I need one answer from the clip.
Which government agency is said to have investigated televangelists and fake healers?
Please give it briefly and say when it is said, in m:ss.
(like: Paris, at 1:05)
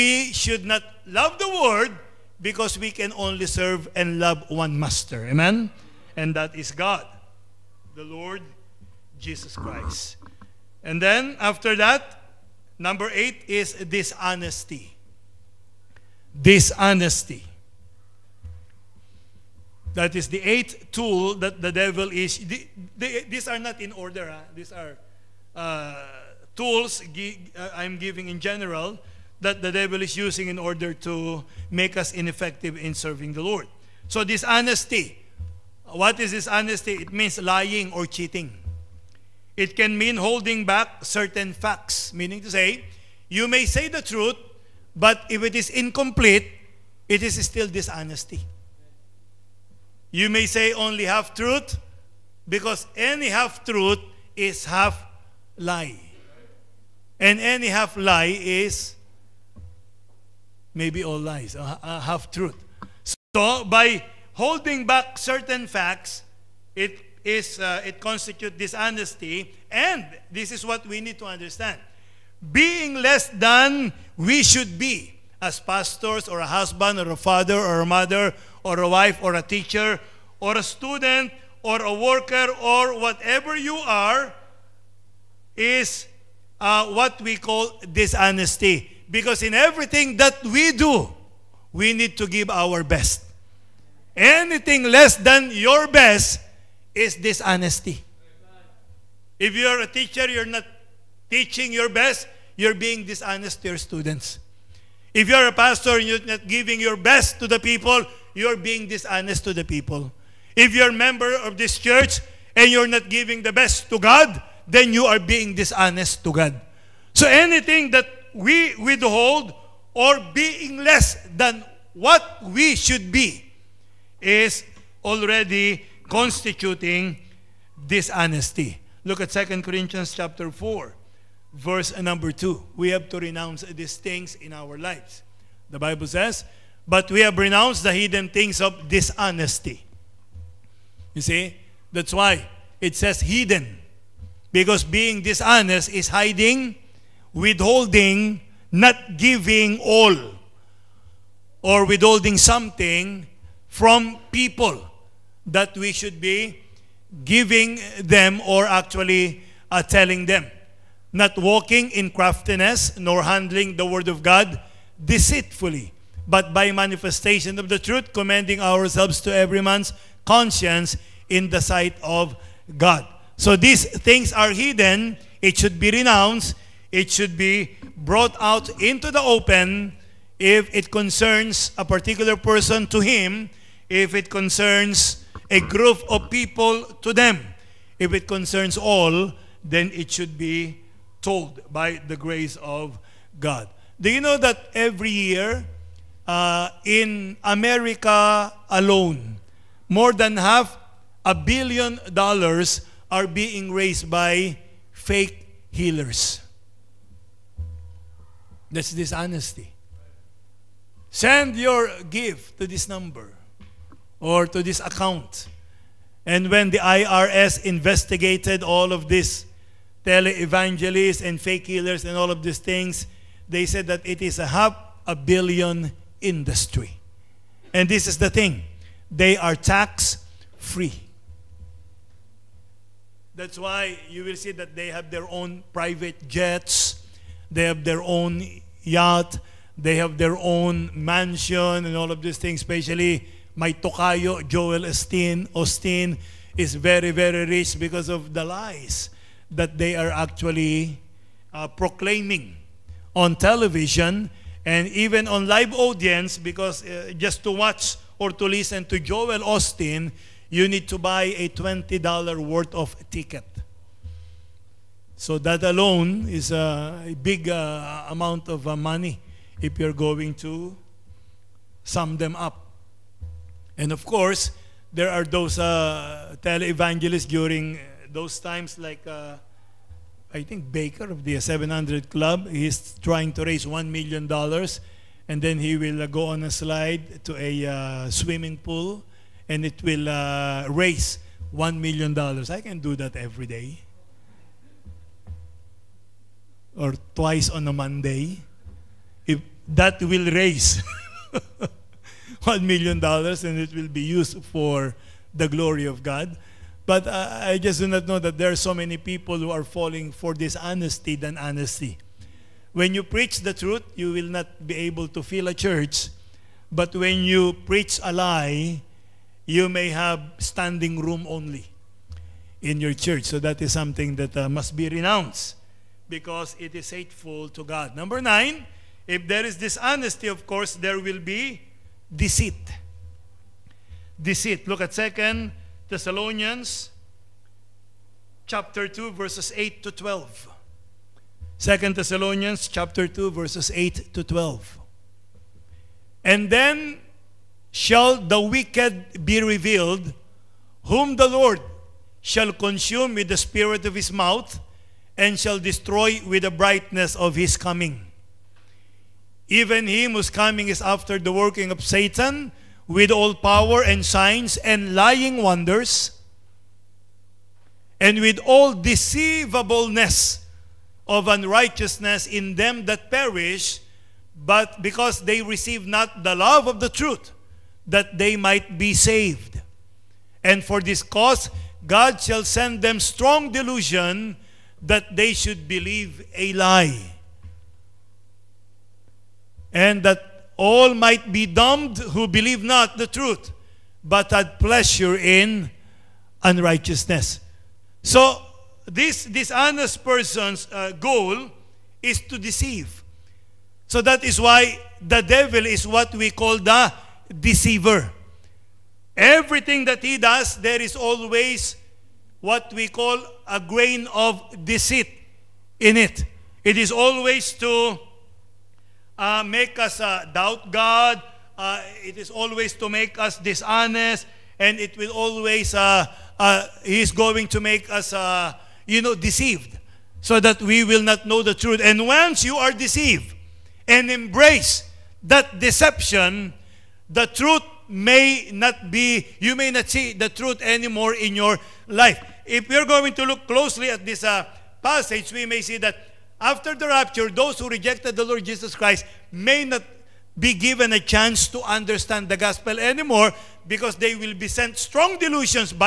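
IRS, at 3:36.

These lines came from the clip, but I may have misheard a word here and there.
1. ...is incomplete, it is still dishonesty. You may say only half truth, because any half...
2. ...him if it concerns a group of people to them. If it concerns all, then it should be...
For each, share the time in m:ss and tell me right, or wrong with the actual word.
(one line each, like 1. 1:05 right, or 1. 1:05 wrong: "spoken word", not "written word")
1. 0:45 right
2. 3:02 right.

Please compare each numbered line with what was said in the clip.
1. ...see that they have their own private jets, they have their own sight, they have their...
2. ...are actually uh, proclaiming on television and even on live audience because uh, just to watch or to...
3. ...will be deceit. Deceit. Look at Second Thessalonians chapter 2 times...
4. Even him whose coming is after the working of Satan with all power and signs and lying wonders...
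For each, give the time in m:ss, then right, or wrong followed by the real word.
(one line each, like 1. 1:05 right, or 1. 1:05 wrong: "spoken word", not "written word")
1. 3:54 wrong: "yacht", not "sight"
2. 4:09 right
3. 5:30 wrong: "verses", not "times"
4. 5:59 right.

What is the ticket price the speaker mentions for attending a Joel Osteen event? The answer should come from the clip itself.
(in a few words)
$20.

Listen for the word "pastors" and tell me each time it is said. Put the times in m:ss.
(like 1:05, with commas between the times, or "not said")
1:15, 1:45.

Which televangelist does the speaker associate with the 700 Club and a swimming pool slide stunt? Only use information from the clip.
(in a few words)
Bakker.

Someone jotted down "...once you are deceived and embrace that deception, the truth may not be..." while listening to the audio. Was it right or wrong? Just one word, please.
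right.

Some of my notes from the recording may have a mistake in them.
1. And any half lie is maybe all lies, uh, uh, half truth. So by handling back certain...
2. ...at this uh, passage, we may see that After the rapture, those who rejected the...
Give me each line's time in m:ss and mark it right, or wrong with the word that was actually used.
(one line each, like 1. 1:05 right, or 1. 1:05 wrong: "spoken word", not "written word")
1. 0:57 wrong: "holding", not "handling"
2. 7:23 right.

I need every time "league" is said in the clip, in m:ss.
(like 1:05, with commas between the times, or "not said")
not said.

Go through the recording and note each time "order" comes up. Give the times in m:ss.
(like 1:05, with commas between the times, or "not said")
0:23, 0:30.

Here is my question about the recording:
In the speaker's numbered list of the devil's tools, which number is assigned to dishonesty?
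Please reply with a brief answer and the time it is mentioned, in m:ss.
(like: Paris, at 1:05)
8, at 0:12.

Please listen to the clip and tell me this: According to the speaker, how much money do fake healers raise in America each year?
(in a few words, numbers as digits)
more than half a billion dollars.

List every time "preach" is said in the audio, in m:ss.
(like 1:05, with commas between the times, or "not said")
5:13, 5:17.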